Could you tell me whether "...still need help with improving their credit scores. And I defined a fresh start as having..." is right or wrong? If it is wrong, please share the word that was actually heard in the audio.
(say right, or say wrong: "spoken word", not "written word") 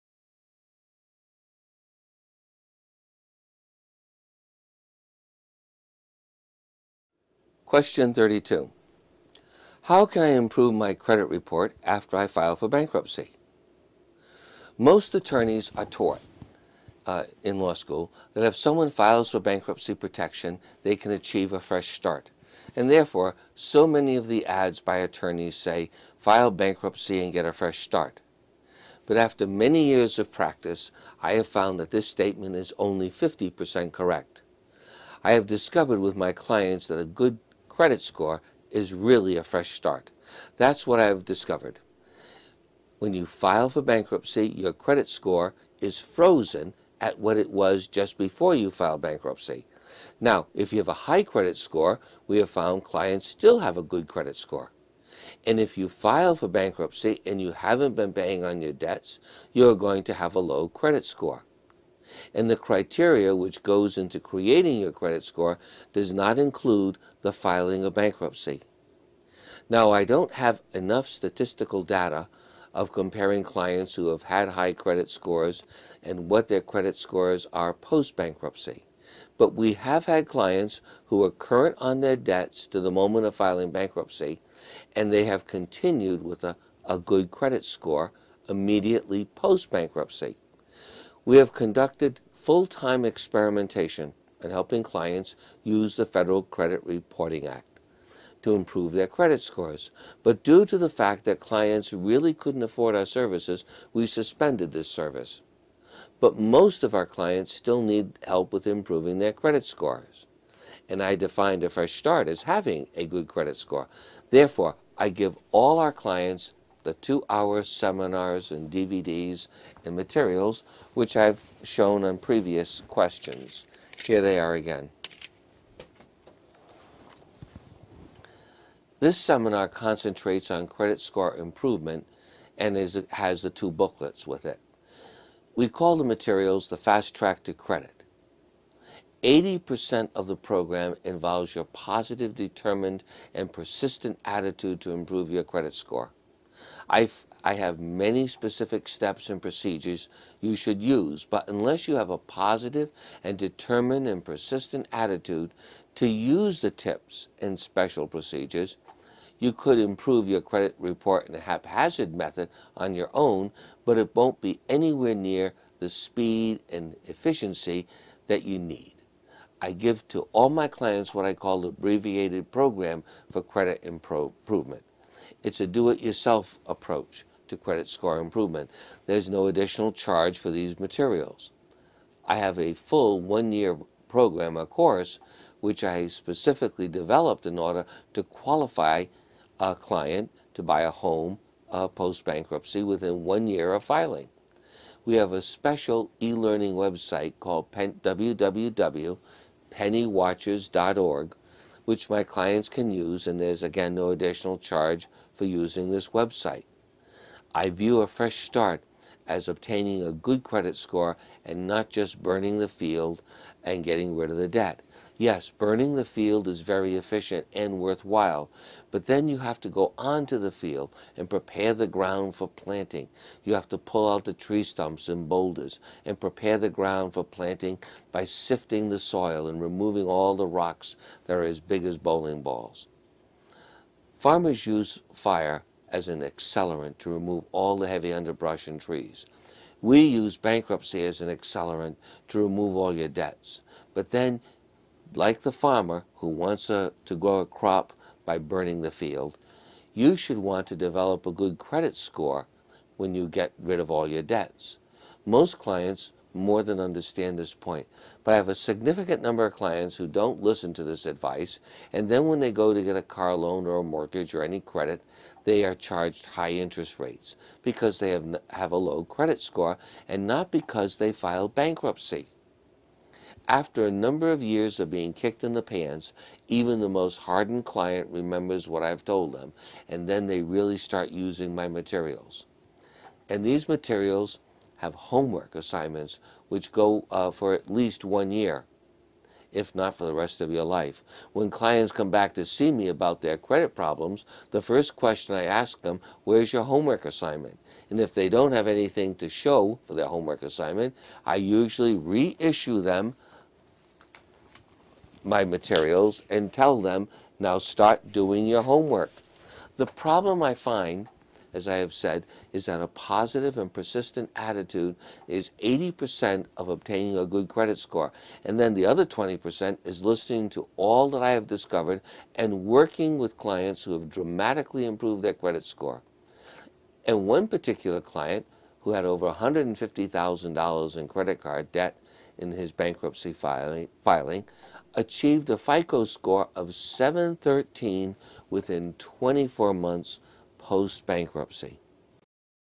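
right.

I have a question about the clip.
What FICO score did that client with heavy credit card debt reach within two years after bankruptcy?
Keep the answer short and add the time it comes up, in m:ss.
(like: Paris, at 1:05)
713, at 5:36.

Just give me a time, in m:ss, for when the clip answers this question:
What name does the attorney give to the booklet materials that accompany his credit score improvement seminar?
2:16.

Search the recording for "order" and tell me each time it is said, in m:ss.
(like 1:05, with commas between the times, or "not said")
3:07.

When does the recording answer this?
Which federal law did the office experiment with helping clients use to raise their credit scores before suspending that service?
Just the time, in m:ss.
1:36.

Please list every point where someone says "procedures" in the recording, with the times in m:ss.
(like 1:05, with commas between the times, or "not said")
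2:29, 2:38.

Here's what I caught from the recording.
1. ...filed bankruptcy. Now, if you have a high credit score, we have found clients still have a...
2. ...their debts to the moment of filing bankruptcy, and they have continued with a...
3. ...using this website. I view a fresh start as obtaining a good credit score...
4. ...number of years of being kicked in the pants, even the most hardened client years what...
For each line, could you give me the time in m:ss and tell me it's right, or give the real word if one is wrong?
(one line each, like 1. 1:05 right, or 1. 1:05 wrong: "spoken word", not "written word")
1. 0:48 right
2. 1:21 right
3. 3:25 right
4. 4:33 wrong: "remembers", not "years".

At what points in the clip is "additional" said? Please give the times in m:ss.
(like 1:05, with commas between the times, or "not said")
2:59, 3:24.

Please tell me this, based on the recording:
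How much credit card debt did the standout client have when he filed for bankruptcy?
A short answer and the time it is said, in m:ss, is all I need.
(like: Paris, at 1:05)
$150,000, at 5:29.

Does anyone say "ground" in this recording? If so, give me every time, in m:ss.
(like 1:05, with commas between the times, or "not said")
3:41, 3:46.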